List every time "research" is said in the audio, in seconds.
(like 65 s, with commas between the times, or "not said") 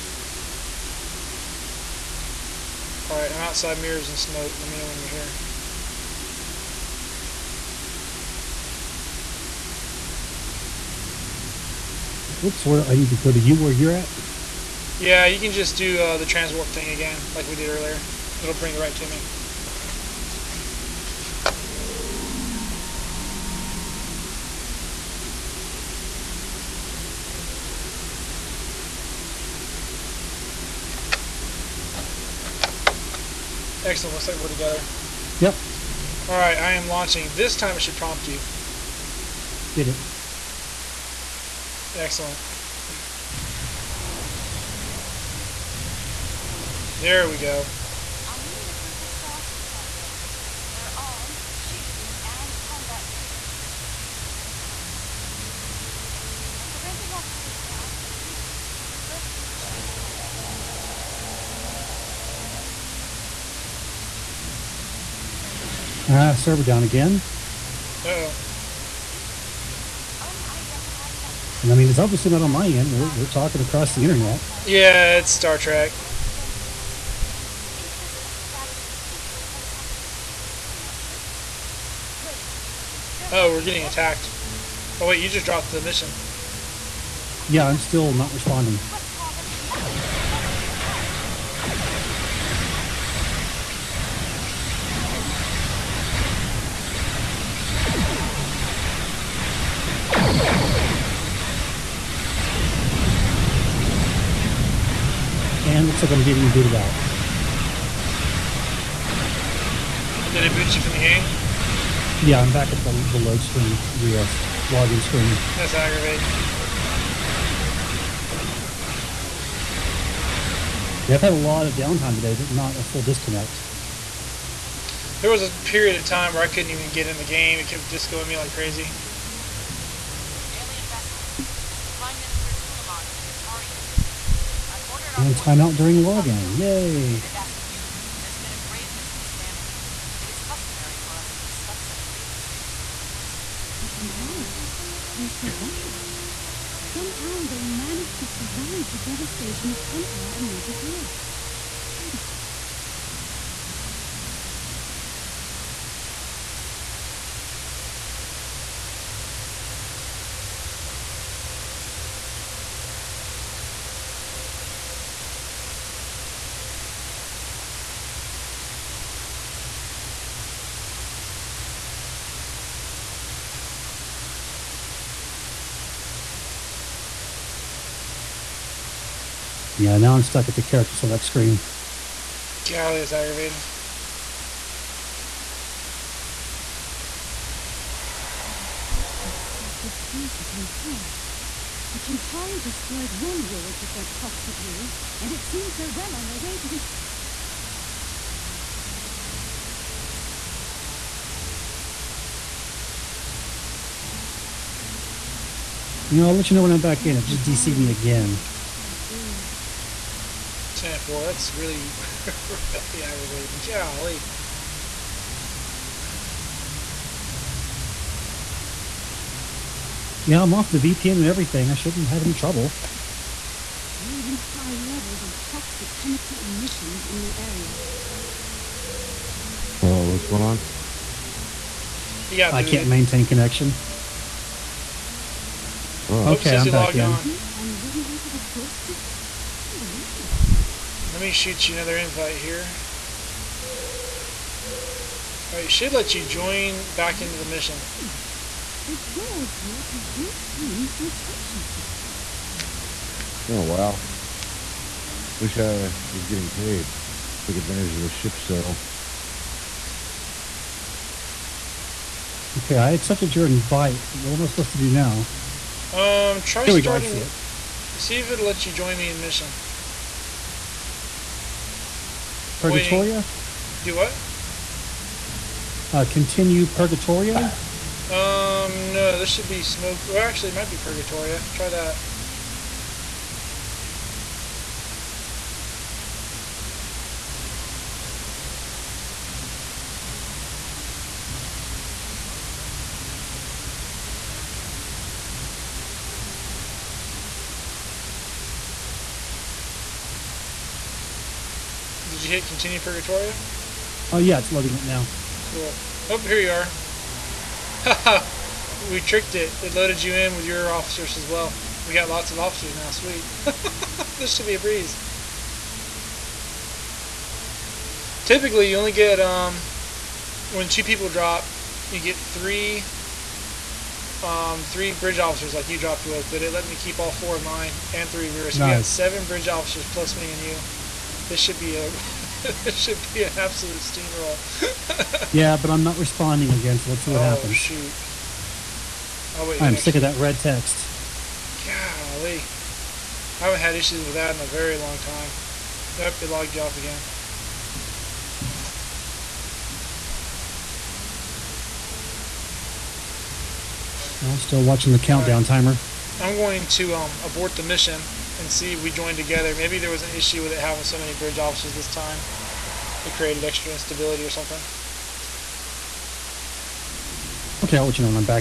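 not said.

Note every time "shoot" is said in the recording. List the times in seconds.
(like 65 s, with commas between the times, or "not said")
241 s, 337 s.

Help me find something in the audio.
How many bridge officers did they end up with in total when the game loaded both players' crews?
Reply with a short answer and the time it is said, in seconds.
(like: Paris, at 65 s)
7, at 328 s.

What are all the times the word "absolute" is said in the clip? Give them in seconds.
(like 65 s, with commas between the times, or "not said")
333 s.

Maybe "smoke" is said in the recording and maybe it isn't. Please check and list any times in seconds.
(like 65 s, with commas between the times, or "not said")
4 s, 279 s.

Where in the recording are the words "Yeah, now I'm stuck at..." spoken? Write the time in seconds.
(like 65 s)
179 s.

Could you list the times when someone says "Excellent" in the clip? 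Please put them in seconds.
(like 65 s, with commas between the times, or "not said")
33 s, 41 s.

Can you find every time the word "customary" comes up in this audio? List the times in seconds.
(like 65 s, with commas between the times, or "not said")
140 s.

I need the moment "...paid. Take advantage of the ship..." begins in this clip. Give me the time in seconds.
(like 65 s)
256 s.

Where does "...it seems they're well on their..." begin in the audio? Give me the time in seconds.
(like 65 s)
195 s.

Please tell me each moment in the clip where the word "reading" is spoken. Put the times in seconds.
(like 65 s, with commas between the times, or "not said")
48 s, 224 s.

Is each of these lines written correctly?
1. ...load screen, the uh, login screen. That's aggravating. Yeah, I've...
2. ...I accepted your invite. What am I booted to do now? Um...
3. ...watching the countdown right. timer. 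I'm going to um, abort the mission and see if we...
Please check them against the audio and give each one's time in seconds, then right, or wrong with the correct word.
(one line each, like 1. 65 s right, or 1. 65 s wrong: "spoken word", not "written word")
1. 113 s right
2. 262 s wrong: "supposed", not "booted"
3. 354 s right.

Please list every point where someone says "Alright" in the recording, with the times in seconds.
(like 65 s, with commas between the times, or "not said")
3 s, 245 s.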